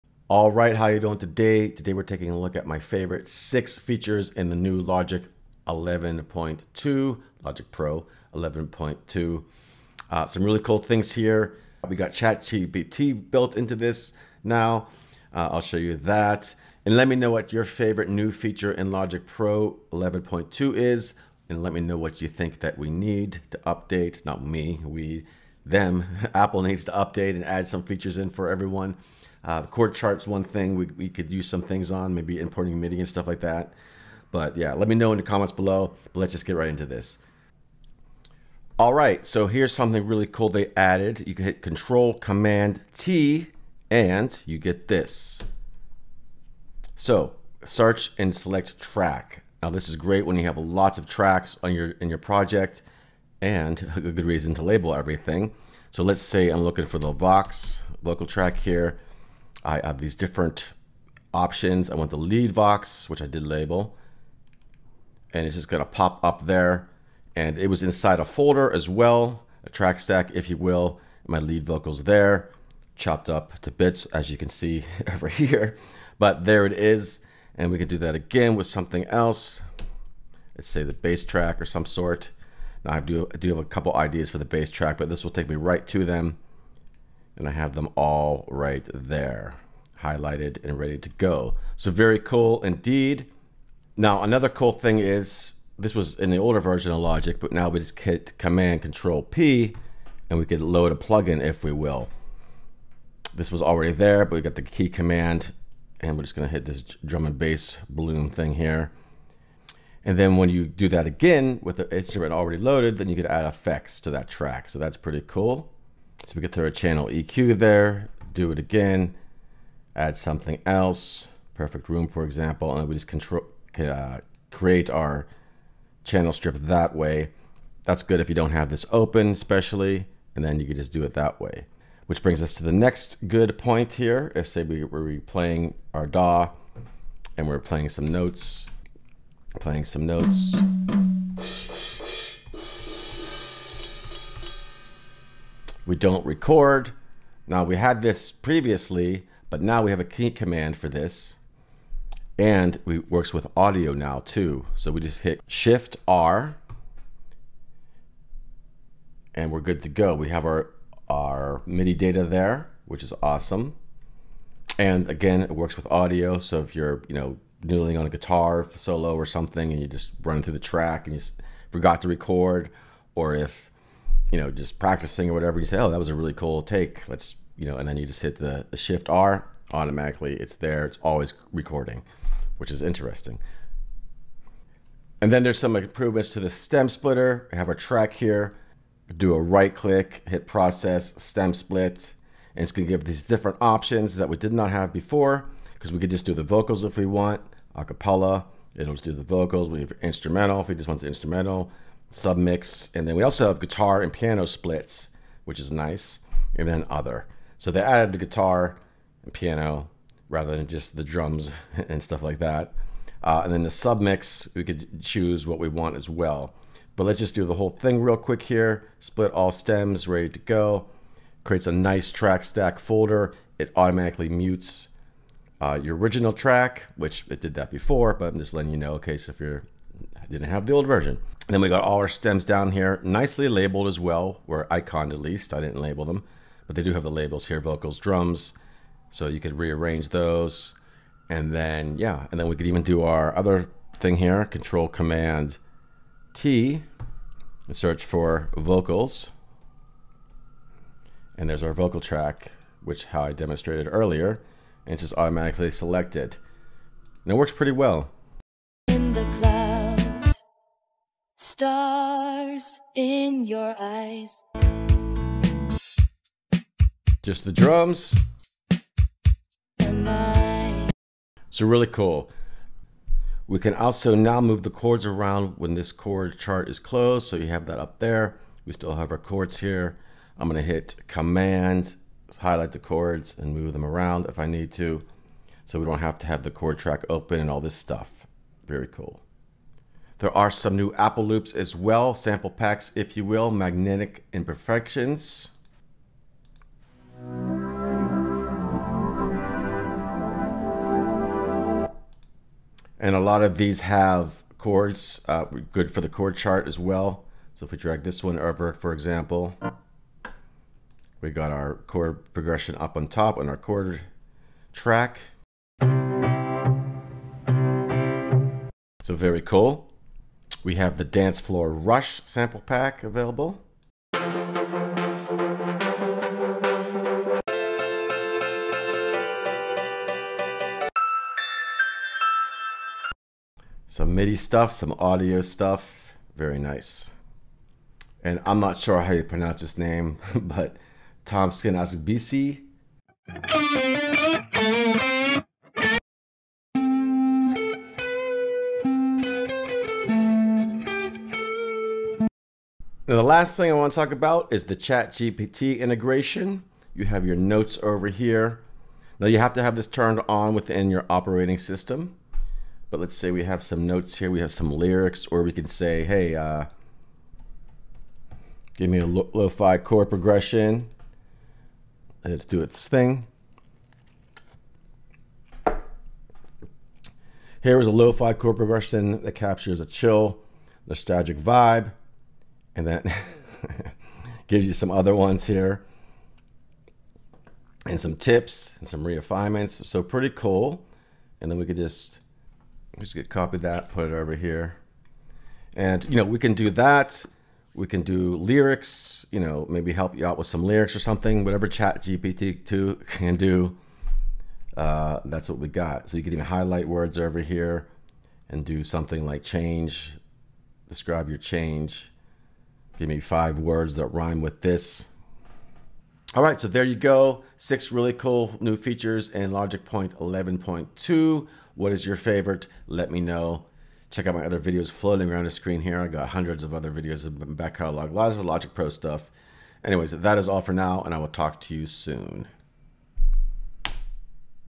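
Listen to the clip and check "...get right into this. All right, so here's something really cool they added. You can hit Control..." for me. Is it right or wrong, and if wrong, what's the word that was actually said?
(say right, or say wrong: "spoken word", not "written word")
right.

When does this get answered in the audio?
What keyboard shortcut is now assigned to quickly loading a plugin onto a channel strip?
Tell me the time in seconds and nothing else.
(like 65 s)
98 s.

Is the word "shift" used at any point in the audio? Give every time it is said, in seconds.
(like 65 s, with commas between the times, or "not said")
155 s, 178 s.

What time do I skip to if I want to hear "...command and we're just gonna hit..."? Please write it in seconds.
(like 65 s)
104 s.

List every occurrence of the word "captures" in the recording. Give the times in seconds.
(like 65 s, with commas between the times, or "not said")
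379 s.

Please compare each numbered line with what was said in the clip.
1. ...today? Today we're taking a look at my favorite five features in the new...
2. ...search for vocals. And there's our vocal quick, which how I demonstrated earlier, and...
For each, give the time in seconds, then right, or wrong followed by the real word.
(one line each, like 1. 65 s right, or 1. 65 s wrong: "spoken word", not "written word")
1. 1 s wrong: "six", not "five"
2. 247 s wrong: "track", not "quick".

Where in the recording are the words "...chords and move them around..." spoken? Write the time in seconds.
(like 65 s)
282 s.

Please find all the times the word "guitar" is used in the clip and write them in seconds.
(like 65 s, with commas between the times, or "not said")
168 s, 203 s, 208 s.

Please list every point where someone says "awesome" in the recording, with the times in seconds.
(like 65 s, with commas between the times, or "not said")
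163 s.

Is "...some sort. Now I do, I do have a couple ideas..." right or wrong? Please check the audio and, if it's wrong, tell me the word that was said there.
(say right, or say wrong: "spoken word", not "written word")
right.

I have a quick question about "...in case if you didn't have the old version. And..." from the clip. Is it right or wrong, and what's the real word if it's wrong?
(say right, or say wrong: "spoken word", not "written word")
right.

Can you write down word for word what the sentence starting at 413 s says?
Give me five words that rhyme with this.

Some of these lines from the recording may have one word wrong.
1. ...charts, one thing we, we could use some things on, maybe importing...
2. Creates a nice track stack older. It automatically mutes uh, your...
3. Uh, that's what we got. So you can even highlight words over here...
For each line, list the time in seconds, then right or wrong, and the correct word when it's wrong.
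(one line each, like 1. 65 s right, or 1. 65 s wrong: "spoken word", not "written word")
1. 29 s right
2. 221 s wrong: "folder", not "older"
3. 404 s right.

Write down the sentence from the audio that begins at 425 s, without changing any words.
I got hundreds of other videos of back catalog, lots of Logic Pro stuff.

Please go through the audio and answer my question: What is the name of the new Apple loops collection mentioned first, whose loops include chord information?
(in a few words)
Magnetic Imperfections.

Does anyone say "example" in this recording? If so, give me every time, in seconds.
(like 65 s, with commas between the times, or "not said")
122 s, 308 s.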